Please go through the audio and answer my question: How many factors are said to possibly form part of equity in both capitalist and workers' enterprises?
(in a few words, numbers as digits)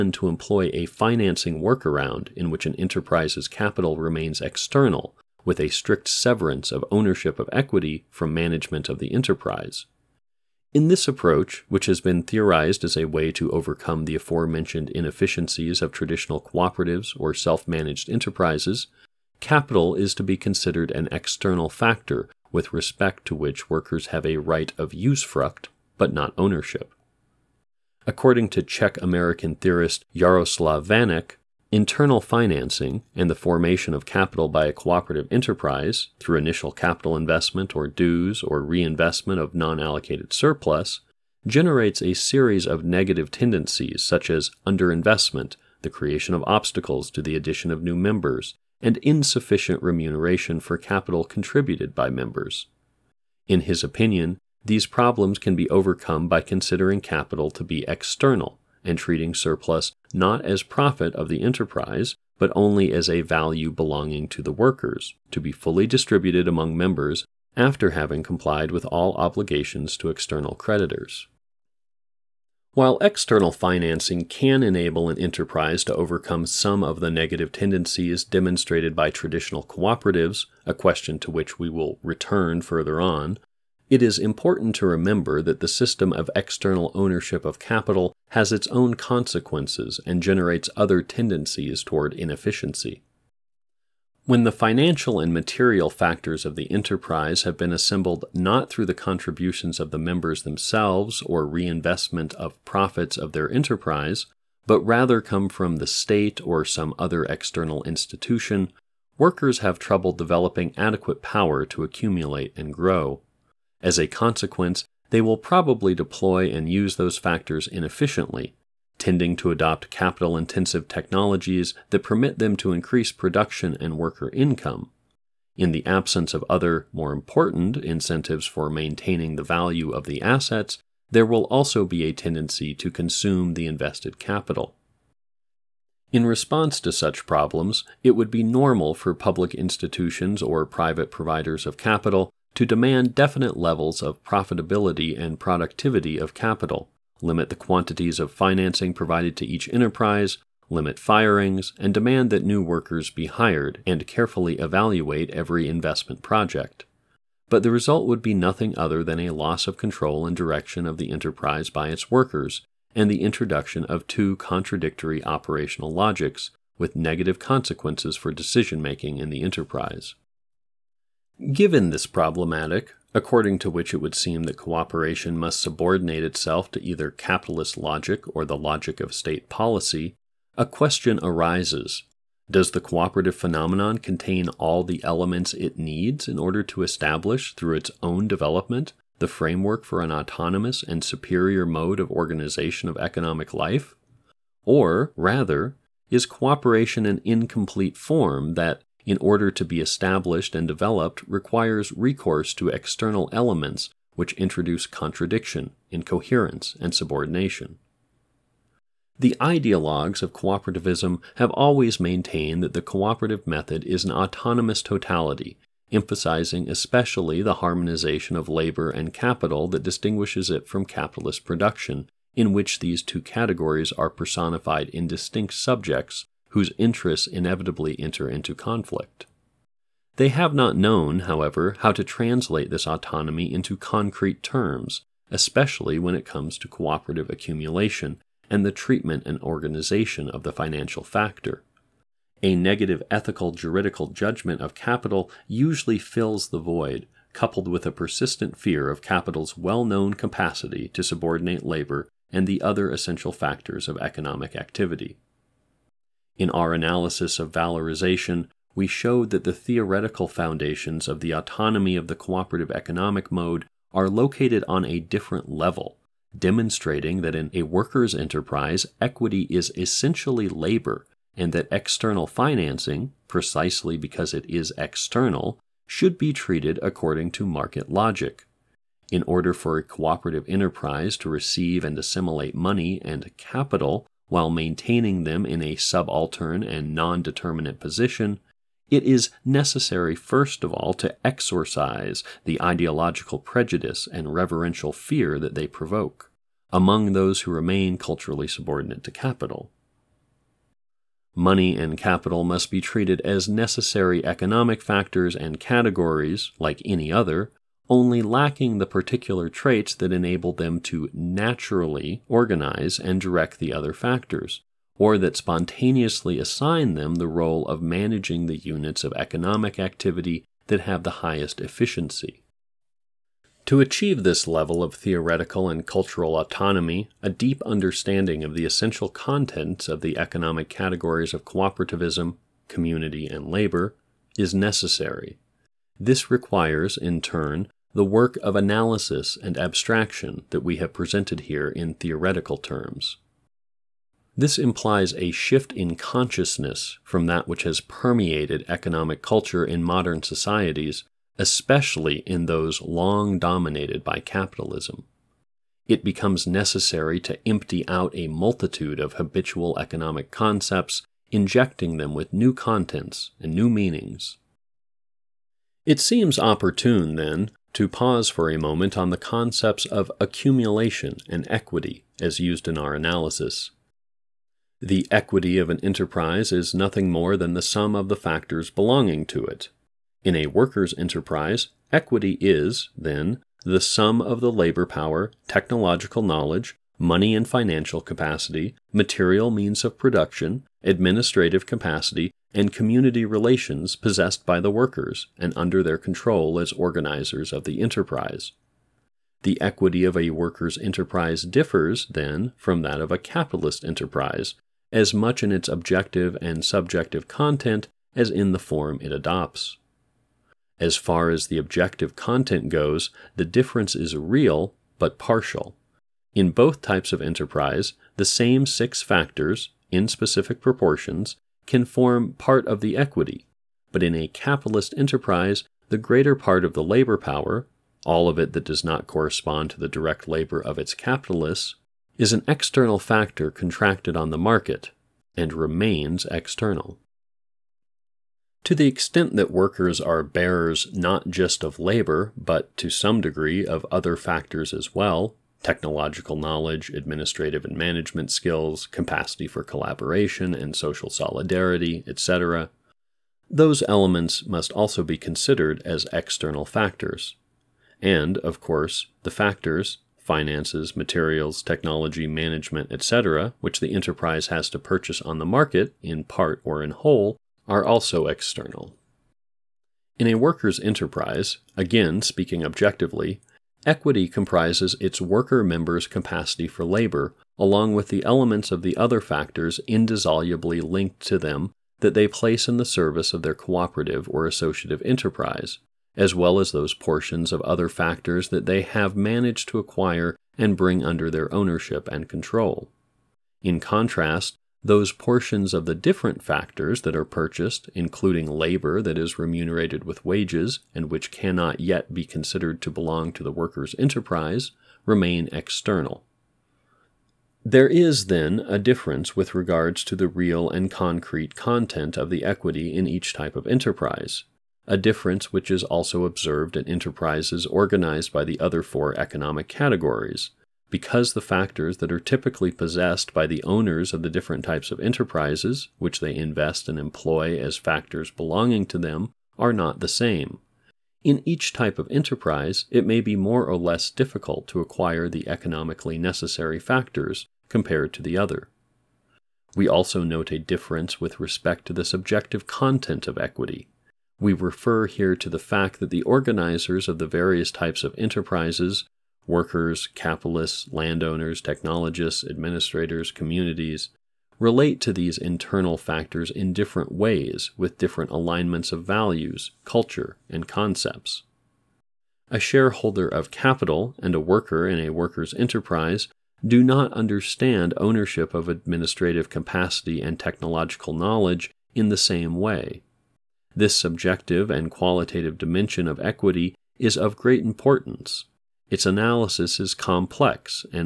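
6.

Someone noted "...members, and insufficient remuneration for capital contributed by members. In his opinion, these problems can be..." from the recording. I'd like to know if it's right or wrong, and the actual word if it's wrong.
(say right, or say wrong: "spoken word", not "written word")
right.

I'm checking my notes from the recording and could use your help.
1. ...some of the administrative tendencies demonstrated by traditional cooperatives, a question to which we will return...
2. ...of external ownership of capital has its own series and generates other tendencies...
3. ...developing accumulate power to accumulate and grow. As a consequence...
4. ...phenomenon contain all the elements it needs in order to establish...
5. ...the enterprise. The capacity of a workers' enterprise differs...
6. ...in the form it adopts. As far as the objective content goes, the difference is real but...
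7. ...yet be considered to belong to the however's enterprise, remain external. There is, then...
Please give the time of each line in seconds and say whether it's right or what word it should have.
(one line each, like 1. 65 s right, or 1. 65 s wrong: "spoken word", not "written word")
1. 76 s wrong: "negative", not "administrative"
2. 86 s wrong: "consequences", not "series"
3. 110 s wrong: "adequate", not "accumulate"
4. 183 s right
5. 397 s wrong: "equity", not "capacity"
6. 408 s right
7. 501 s wrong: "worker", not "however".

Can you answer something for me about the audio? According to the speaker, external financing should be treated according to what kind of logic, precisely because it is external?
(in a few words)
market logic.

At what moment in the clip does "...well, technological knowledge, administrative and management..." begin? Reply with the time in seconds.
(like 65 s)
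444 s.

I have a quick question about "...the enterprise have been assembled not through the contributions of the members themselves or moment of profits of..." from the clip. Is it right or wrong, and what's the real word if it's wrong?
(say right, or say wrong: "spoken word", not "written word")
wrong: "reinvestment", not "moment".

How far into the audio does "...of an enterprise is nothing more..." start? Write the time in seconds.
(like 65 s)
375 s.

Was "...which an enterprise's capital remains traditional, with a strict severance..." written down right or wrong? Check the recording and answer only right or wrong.
wrong.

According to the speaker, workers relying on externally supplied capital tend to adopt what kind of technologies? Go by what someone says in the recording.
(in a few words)
capital intensive.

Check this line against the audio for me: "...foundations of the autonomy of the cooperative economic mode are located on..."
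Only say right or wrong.
right.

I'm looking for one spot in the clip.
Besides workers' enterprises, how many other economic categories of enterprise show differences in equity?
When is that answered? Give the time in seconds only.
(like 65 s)
518 s.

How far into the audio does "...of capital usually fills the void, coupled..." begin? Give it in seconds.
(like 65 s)
244 s.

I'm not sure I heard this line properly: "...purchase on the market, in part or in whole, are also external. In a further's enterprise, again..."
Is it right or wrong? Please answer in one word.
wrong.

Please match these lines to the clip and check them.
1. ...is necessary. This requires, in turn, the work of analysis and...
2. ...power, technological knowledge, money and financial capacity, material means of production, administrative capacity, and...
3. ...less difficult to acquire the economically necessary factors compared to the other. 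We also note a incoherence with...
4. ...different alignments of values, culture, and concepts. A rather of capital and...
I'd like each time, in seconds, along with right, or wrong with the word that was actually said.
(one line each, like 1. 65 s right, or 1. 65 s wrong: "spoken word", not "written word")
1. 334 s right
2. 384 s right
3. 533 s wrong: "difference", not "incoherence"
4. 557 s wrong: "shareholder", not "rather".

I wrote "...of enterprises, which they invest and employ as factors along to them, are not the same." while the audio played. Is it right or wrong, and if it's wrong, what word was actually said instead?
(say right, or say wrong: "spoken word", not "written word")
wrong: "belonging", not "along".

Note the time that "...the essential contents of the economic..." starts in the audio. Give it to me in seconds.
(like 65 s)
328 s.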